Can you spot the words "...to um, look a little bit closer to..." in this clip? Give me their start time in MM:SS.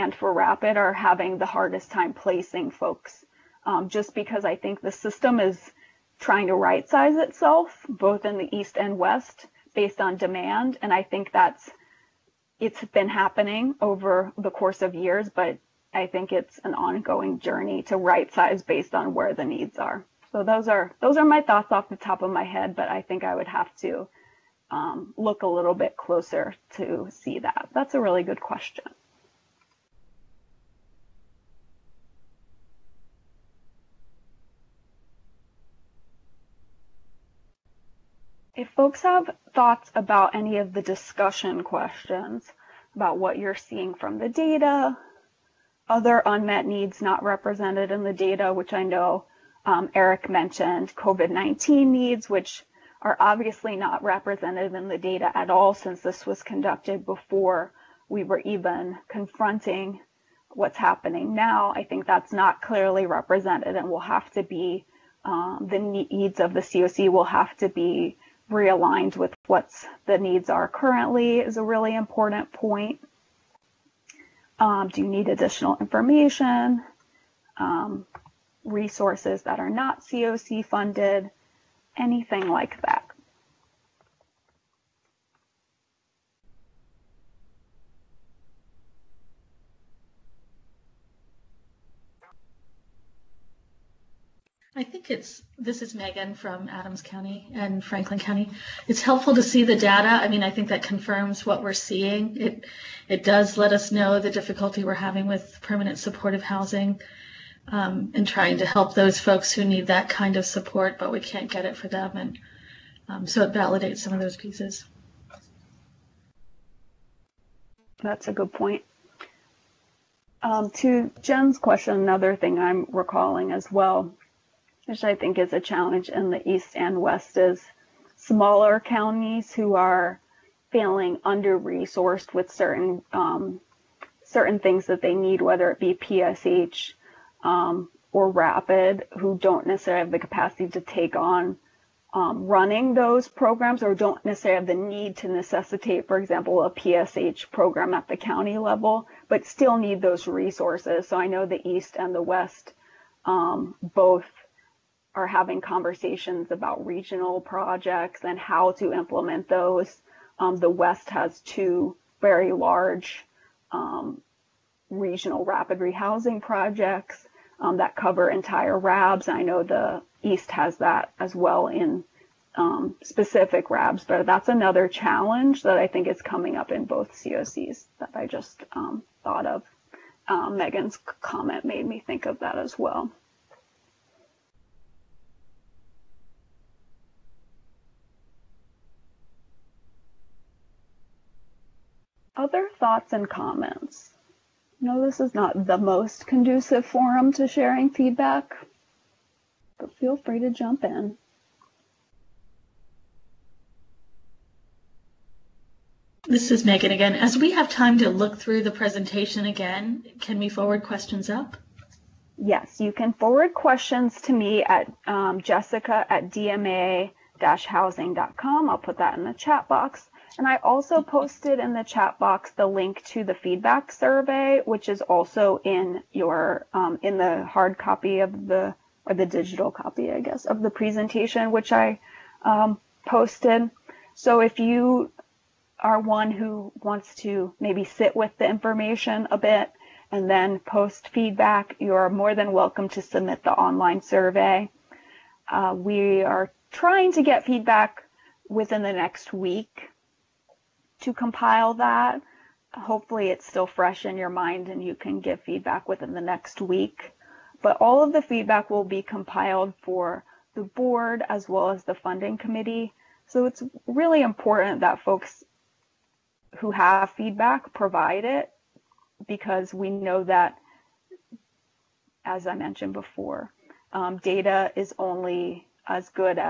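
00:23.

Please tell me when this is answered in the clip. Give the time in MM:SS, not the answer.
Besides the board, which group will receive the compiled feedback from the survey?
04:21.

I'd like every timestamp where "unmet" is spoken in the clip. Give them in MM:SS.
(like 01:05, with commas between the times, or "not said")
00:46.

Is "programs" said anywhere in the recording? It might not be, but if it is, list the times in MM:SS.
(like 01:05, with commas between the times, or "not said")
02:23, 02:27.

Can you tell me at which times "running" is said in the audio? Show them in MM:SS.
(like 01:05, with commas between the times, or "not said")
02:22.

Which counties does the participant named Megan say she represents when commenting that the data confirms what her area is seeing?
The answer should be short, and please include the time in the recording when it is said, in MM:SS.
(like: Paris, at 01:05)
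Adams County and Franklin County, at 01:36.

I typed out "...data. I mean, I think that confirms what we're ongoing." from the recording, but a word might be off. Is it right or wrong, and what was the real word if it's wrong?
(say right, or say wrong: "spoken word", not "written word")
wrong: "seeing", not "ongoing".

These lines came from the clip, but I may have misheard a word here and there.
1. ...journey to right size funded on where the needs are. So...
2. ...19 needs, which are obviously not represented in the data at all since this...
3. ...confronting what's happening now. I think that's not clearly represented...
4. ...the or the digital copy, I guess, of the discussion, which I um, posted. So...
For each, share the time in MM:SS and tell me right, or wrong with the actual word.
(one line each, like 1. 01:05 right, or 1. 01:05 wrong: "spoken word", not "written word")
1. 00:17 wrong: "based", not "funded"
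2. 00:51 right
3. 00:59 right
4. 03:48 wrong: "presentation", not "discussion".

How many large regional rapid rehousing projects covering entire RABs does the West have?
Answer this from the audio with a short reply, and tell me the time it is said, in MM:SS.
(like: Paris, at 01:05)
2, at 02:41.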